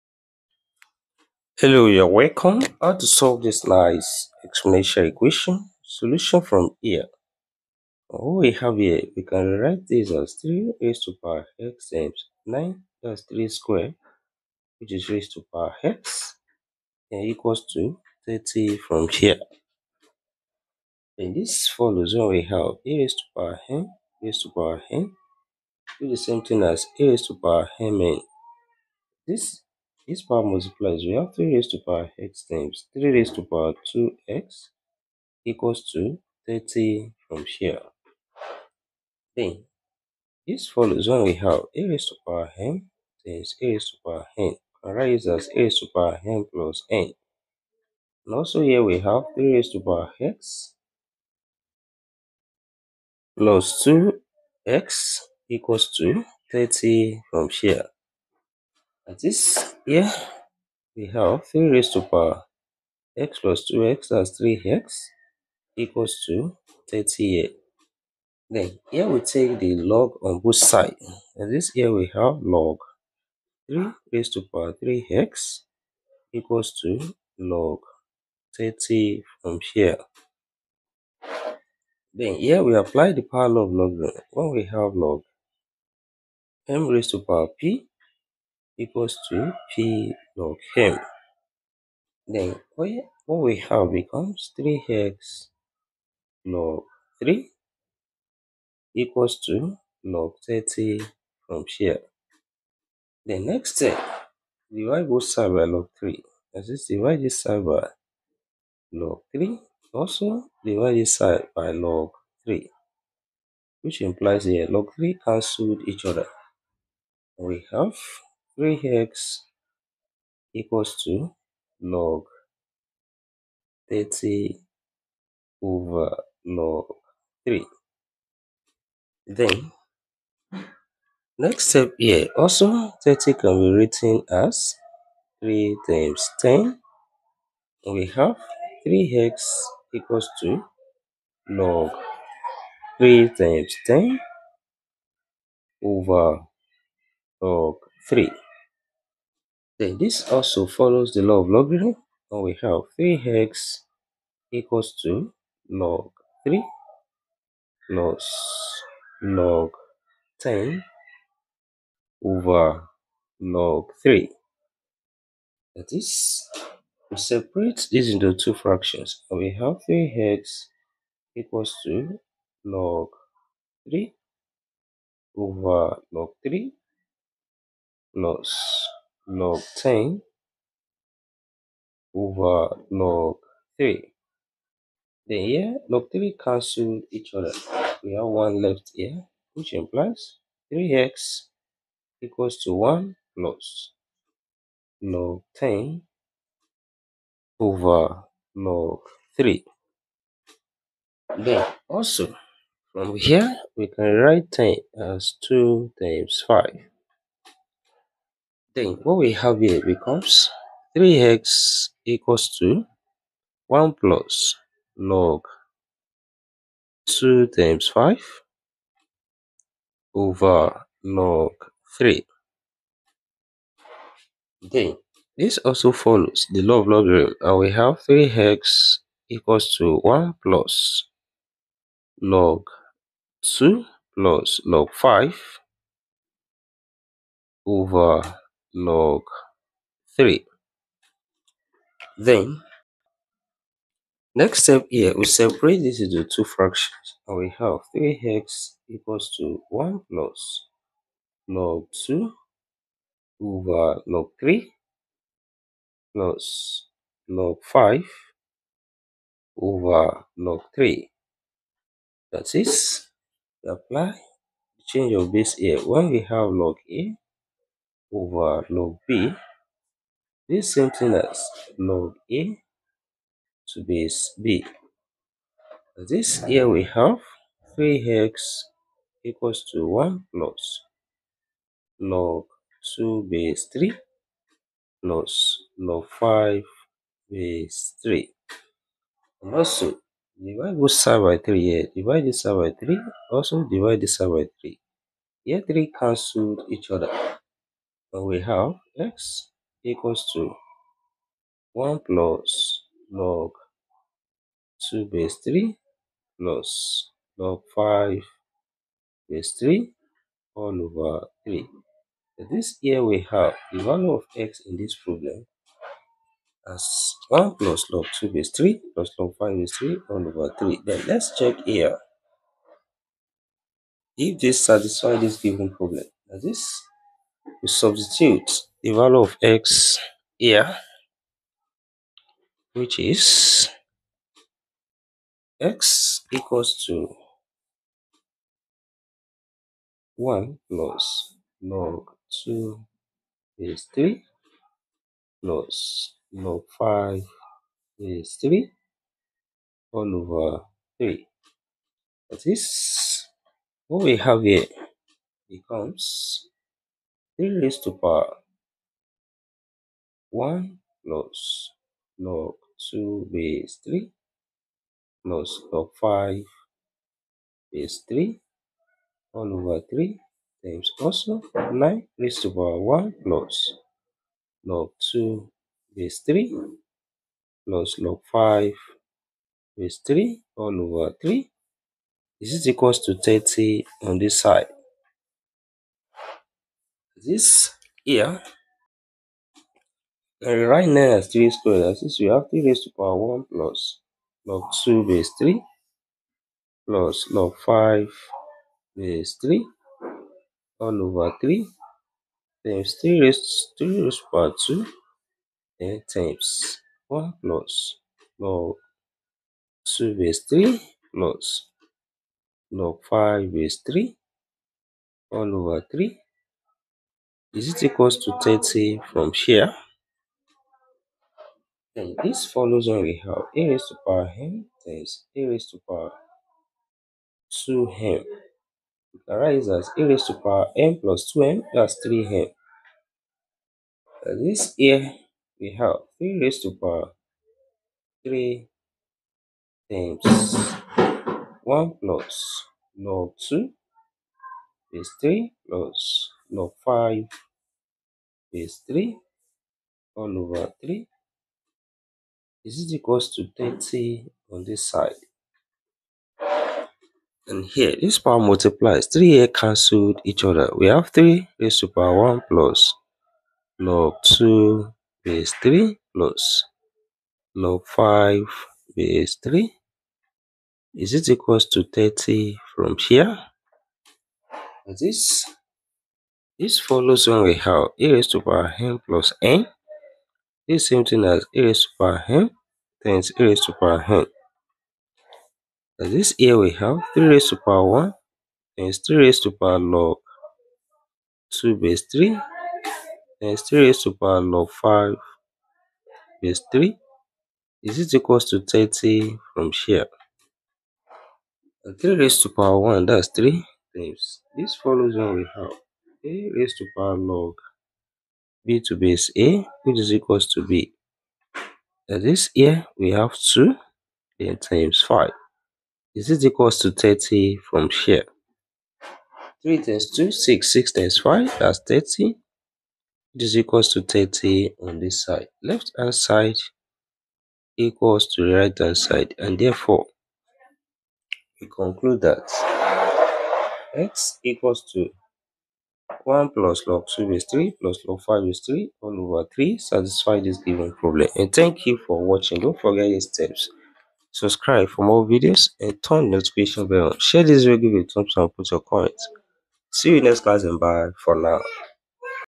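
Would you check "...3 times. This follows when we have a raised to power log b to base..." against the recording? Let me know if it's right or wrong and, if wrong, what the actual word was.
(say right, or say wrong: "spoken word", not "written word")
right.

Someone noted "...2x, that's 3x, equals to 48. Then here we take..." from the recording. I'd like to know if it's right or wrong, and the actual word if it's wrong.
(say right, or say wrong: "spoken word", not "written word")
wrong: "38", not "48".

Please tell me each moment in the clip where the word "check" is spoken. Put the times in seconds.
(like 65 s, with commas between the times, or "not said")
321 s.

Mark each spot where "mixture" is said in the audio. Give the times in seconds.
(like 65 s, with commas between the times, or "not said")
not said.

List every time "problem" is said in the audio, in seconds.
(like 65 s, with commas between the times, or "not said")
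315 s, 325 s, 540 s.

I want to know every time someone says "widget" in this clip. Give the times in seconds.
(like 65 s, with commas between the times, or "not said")
not said.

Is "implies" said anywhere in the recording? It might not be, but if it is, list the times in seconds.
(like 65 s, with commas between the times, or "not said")
114 s, 189 s.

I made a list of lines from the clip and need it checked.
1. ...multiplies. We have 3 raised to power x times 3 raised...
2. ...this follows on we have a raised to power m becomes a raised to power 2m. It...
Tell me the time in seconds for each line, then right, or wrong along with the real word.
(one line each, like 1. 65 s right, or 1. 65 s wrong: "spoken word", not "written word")
1. 30 s right
2. 422 s wrong: "times", not "becomes".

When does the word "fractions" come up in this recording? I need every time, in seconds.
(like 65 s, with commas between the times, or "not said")
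168 s, 246 s.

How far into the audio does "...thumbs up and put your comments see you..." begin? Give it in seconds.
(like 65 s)
548 s.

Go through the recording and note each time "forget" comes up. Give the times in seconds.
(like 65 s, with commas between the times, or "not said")
542 s.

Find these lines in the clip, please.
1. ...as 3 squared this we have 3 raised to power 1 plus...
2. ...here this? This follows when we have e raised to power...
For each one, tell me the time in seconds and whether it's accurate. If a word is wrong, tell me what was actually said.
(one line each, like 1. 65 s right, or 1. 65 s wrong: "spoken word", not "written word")
1. 391 s right
2. 473 s right.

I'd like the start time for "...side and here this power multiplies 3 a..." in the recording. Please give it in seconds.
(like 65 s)
454 s.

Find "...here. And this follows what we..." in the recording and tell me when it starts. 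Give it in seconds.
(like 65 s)
19 s.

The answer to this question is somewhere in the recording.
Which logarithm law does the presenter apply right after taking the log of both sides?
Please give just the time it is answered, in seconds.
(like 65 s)
83 s.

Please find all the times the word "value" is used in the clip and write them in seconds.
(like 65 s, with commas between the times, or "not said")
313 s, 328 s.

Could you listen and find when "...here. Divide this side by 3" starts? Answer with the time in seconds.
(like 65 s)
291 s.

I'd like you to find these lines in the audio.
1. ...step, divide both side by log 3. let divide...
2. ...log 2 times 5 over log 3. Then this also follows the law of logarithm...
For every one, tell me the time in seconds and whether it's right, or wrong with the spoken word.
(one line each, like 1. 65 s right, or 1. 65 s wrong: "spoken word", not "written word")
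1. 103 s right
2. 214 s right.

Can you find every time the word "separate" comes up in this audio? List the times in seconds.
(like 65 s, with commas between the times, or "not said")
167 s, 245 s.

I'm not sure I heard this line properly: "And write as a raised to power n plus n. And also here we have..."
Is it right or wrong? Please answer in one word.
right.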